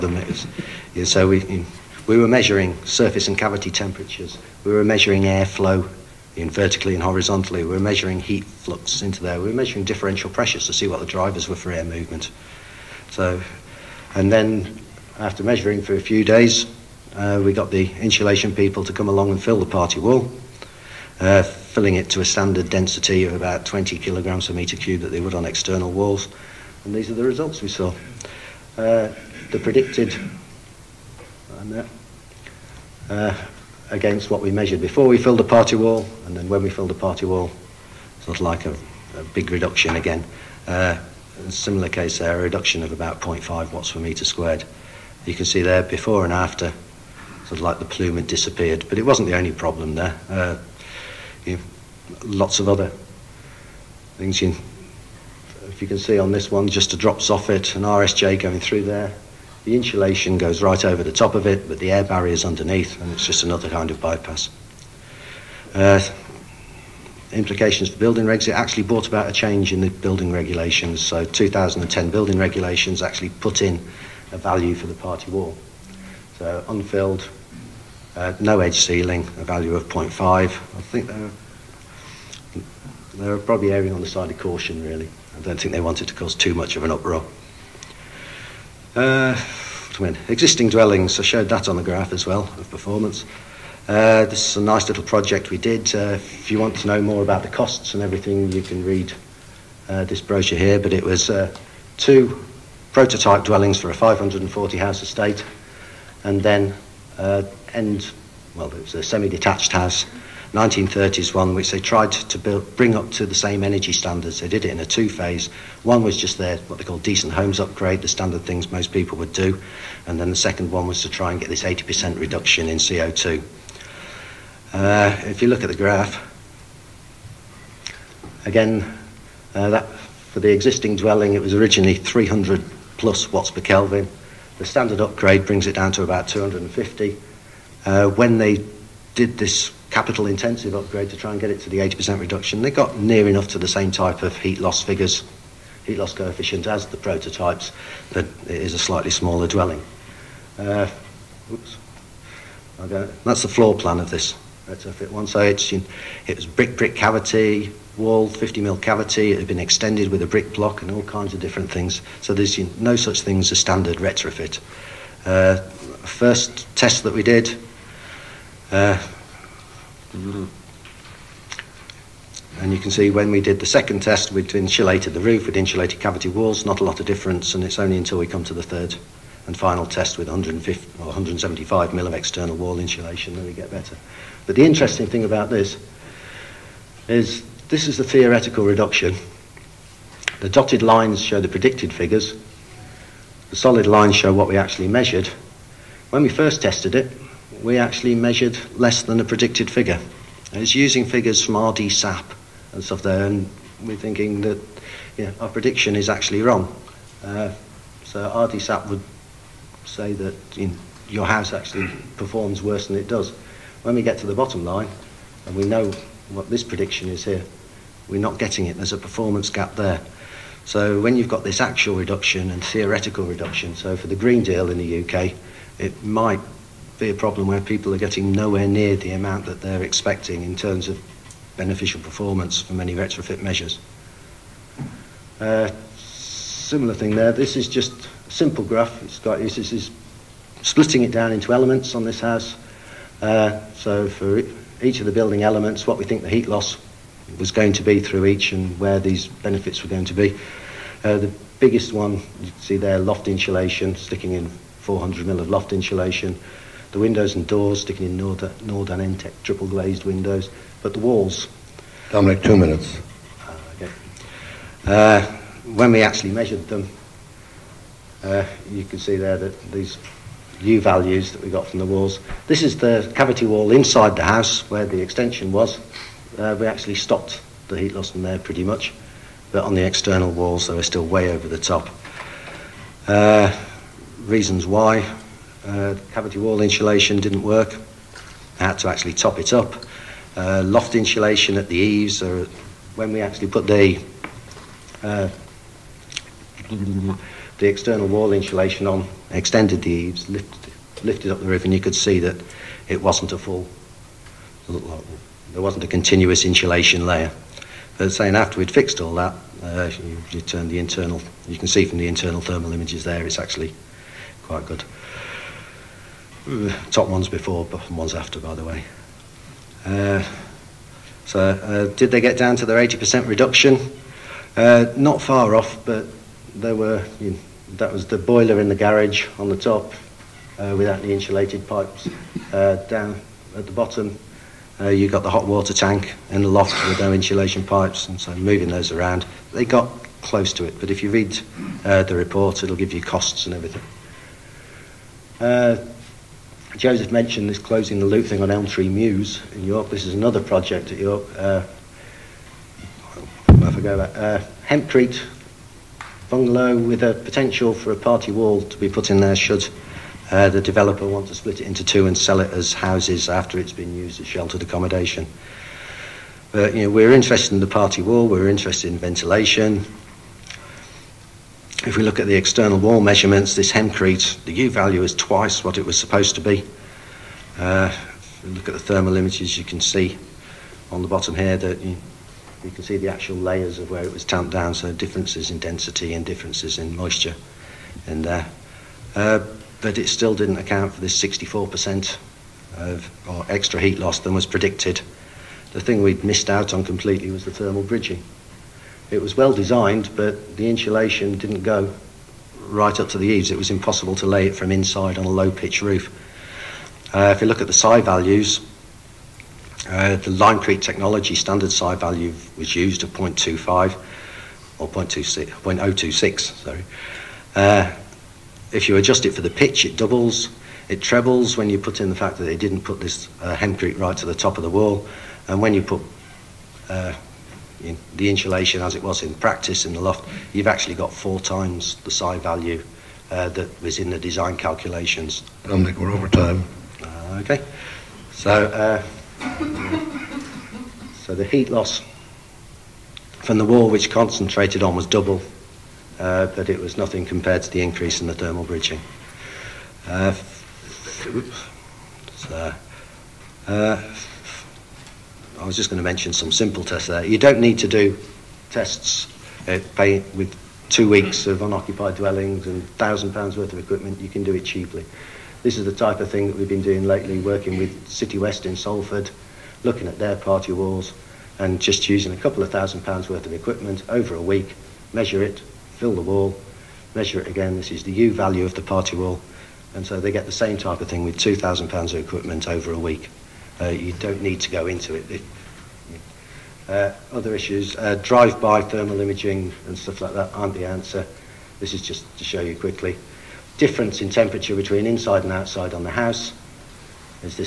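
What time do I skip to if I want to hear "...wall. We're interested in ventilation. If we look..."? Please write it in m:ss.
6:08.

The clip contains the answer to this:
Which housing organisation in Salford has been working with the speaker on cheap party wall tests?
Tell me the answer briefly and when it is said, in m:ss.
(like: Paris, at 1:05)
City West, at 7:48.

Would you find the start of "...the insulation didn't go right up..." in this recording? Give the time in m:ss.
6:40.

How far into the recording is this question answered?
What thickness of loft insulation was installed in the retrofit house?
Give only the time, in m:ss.
4:14.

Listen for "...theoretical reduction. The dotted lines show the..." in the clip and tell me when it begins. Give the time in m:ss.
3:08.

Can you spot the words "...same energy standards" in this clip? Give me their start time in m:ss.
1:53.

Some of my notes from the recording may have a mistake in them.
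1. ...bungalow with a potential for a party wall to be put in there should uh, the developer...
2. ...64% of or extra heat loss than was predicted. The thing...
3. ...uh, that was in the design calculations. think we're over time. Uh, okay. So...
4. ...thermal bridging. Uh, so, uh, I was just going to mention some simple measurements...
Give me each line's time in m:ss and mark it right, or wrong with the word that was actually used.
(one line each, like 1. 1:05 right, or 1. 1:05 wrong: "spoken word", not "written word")
1. 5:56 right
2. 6:31 right
3. 7:13 right
4. 7:28 wrong: "tests", not "measurements".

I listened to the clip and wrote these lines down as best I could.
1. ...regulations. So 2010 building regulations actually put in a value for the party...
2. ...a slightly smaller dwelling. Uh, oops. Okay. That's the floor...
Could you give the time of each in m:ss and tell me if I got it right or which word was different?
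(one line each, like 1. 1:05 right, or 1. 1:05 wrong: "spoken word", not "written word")
1. 1:10 right
2. 2:28 right.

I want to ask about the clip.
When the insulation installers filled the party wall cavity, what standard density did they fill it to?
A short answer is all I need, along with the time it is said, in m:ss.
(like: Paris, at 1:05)
20 kg/m³, at 0:23.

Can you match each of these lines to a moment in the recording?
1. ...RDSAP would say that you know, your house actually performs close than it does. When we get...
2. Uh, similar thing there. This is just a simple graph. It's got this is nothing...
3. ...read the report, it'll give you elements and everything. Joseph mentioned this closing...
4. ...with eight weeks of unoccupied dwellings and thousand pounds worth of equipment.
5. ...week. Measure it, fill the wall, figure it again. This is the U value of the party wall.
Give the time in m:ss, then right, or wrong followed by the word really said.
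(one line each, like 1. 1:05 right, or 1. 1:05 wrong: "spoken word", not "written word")
1. 3:28 wrong: "worse", not "close"
2. 3:55 wrong: "splitting", not "nothing"
3. 5:41 wrong: "costs", not "elements"
4. 7:40 wrong: "two", not "eight"
5. 7:54 wrong: "measure", not "figure".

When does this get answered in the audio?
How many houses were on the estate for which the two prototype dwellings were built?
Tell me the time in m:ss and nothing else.
1:43.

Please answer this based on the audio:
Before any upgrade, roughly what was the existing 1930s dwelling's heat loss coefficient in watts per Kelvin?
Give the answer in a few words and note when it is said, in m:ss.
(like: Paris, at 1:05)
300+, at 2:11.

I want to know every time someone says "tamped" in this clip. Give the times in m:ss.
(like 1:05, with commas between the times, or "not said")
6:24.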